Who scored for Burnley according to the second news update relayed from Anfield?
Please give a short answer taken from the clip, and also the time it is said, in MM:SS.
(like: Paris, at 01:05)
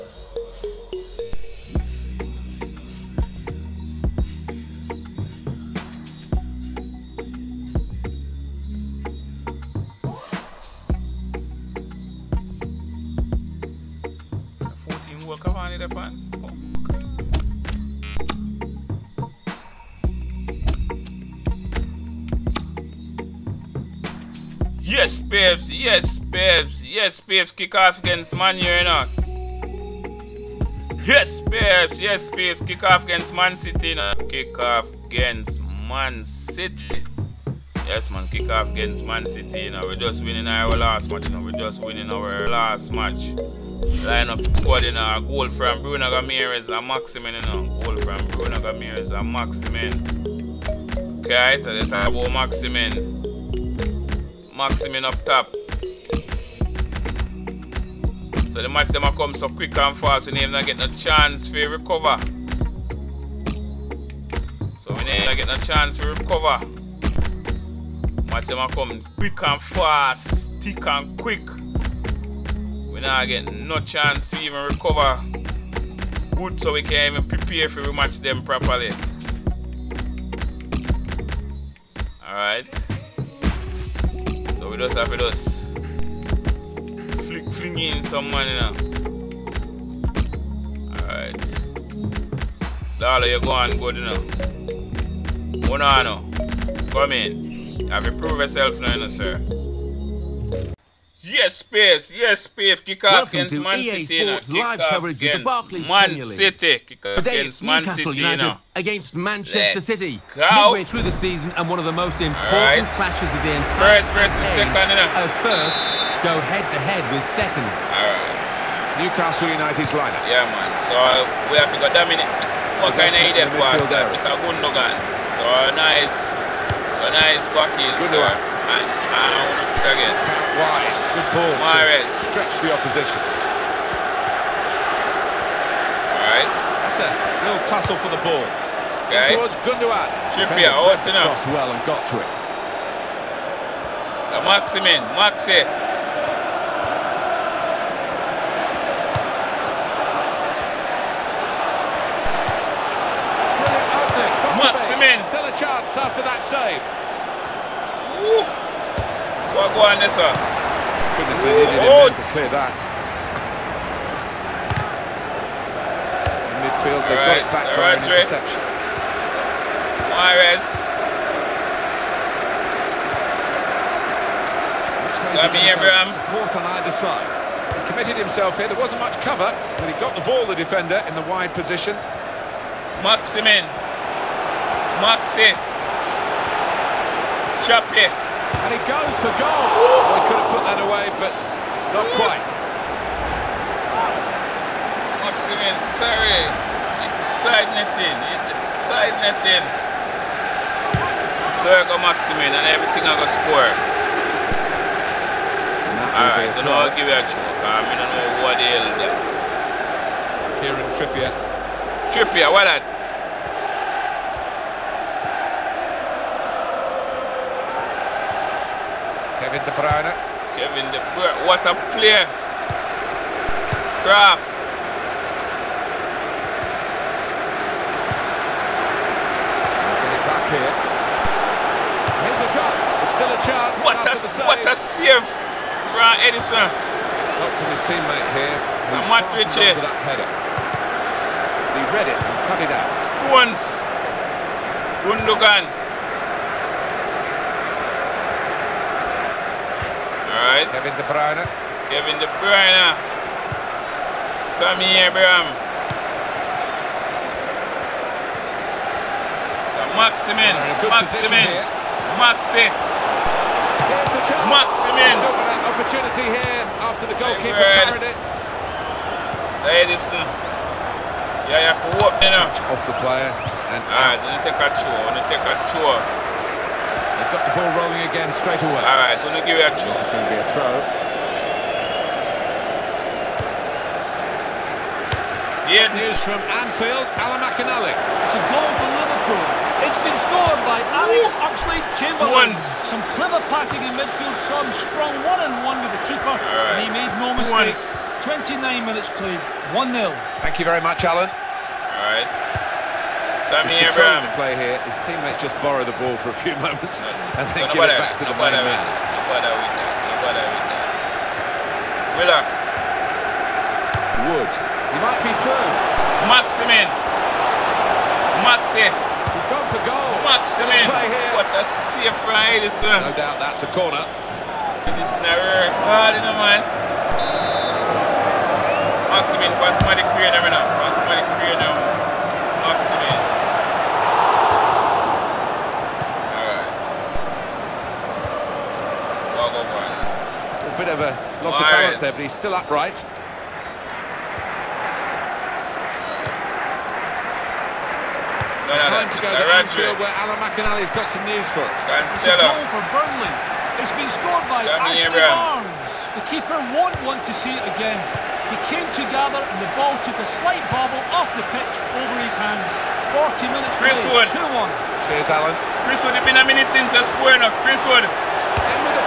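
Ashley Barnes, at 05:54.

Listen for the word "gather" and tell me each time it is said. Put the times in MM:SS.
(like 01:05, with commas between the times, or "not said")
05:59.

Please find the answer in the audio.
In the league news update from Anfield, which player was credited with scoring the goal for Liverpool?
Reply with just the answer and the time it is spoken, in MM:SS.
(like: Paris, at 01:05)
Alex Oxlade-Chamberlain, at 04:50.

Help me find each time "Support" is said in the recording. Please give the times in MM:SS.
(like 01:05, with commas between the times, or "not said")
02:56.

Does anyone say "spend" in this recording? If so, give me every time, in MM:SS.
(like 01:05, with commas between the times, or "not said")
not said.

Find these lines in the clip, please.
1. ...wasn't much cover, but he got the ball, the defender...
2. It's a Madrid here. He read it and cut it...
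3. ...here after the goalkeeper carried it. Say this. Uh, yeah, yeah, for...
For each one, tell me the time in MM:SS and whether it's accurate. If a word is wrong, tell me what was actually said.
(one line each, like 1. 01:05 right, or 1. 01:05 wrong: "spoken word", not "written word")
1. 02:58 right
2. 03:58 right
3. 04:26 right.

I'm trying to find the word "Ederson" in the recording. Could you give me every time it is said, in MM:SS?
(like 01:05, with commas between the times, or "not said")
03:56, 05:22.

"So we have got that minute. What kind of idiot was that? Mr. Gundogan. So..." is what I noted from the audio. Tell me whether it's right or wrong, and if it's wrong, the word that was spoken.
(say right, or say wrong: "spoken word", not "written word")
right.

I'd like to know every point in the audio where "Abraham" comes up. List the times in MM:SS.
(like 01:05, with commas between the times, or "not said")
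02:55, 04:15.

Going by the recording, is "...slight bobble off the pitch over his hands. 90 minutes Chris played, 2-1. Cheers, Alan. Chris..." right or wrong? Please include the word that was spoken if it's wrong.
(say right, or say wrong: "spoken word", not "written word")
wrong: "40", not "90".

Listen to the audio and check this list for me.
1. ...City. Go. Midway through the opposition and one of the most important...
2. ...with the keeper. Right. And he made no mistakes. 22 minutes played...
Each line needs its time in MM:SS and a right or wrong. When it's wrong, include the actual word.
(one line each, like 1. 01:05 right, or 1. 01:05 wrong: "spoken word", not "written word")
1. 01:49 wrong: "season", not "opposition"
2. 04:55 wrong: "29", not "22".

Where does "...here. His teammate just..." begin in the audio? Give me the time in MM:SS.
05:04.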